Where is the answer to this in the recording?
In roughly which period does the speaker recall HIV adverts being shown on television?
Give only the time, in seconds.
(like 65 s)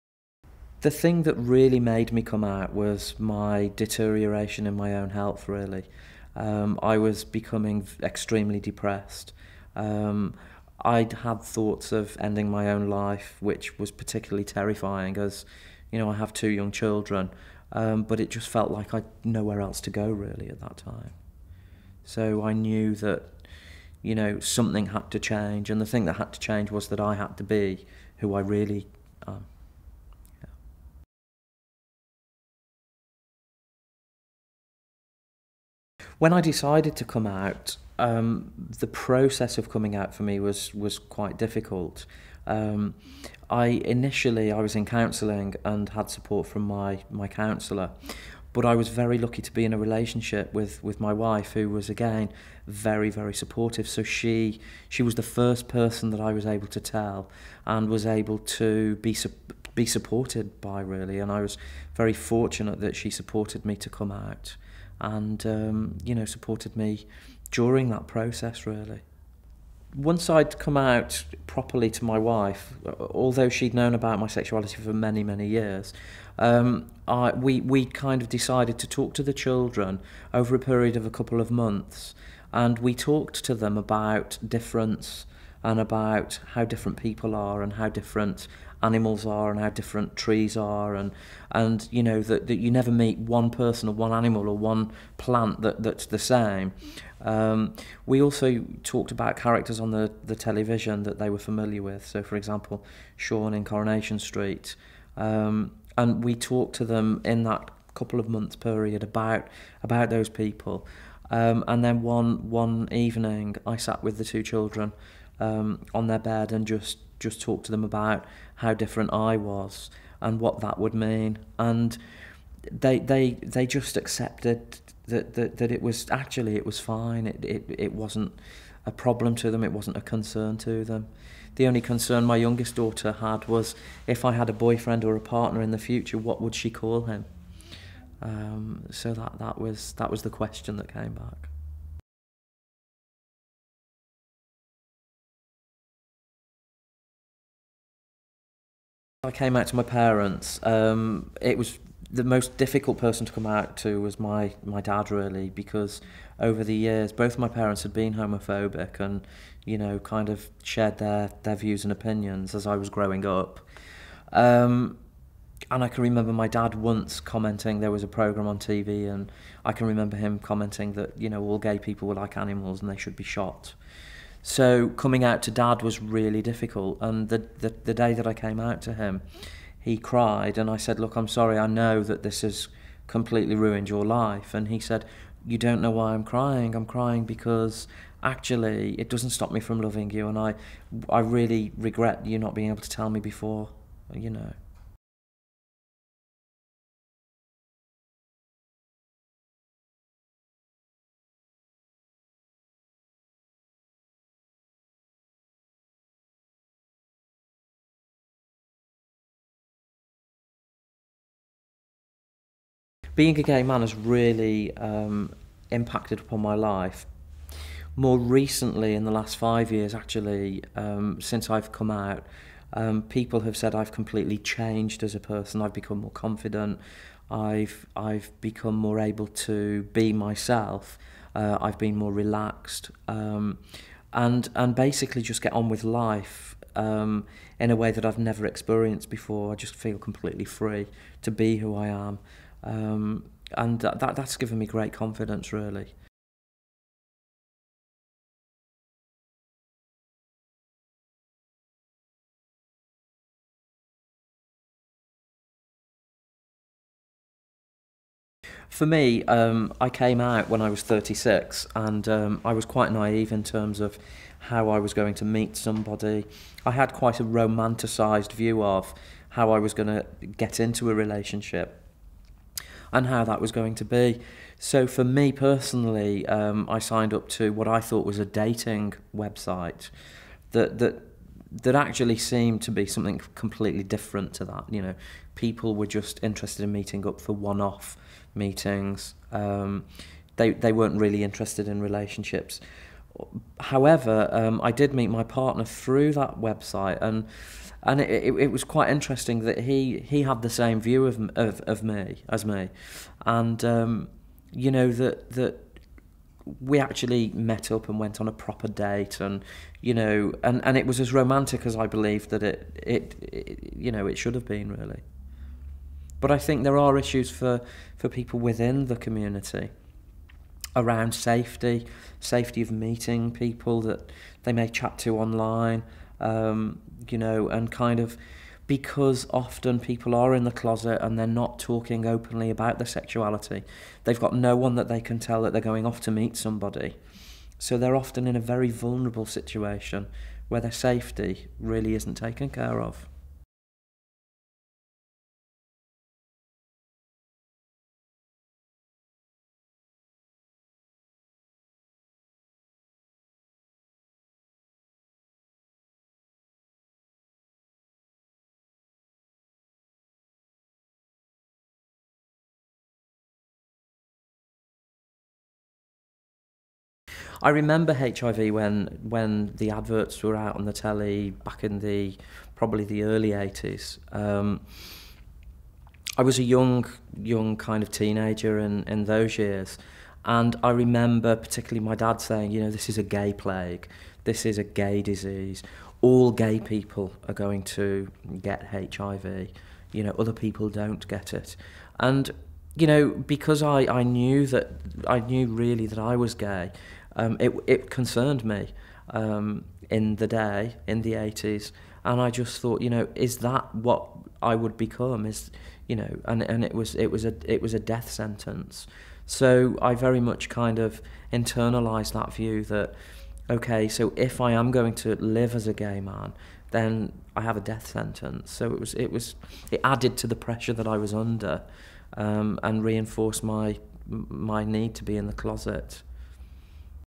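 373 s.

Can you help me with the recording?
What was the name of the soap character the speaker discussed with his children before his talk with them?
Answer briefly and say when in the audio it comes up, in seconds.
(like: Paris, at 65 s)
Sean, at 103 s.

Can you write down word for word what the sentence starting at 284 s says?
You know, people were just interested in meeting up for one-off meetings.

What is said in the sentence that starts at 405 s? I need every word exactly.
Is, you know, and, and it, was, it, was a, it was a death sentence.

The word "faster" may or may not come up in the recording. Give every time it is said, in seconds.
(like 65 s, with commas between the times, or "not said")
not said.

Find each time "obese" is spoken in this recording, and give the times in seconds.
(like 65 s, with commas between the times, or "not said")
not said.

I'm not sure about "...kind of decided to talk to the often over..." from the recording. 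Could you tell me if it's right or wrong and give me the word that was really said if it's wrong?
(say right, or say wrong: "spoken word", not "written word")
wrong: "children", not "often".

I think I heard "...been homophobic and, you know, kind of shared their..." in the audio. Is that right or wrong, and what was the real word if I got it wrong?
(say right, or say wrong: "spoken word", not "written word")
right.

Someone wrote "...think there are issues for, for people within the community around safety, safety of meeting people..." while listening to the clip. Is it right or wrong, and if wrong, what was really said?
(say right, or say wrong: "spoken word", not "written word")
right.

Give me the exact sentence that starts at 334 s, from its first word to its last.
They've got no one that they can tell that they're going off to meet somebody.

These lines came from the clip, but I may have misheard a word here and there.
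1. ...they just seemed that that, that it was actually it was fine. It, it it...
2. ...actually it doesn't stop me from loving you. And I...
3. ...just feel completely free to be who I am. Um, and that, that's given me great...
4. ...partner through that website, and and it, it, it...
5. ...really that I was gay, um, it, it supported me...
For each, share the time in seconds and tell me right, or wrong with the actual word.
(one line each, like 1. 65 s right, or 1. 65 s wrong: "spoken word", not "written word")
1. 123 s wrong: "accepted", not "seemed"
2. 188 s right
3. 239 s right
4. 295 s right
5. 395 s wrong: "concerned", not "supported".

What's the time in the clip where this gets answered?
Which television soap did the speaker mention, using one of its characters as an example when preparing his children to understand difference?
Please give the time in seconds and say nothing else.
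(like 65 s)
103 s.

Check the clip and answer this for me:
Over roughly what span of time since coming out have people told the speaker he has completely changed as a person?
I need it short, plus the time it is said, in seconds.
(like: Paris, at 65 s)
5 years, at 219 s.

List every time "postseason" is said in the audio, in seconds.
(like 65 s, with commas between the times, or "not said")
not said.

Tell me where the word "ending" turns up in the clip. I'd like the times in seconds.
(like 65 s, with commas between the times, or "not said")
12 s.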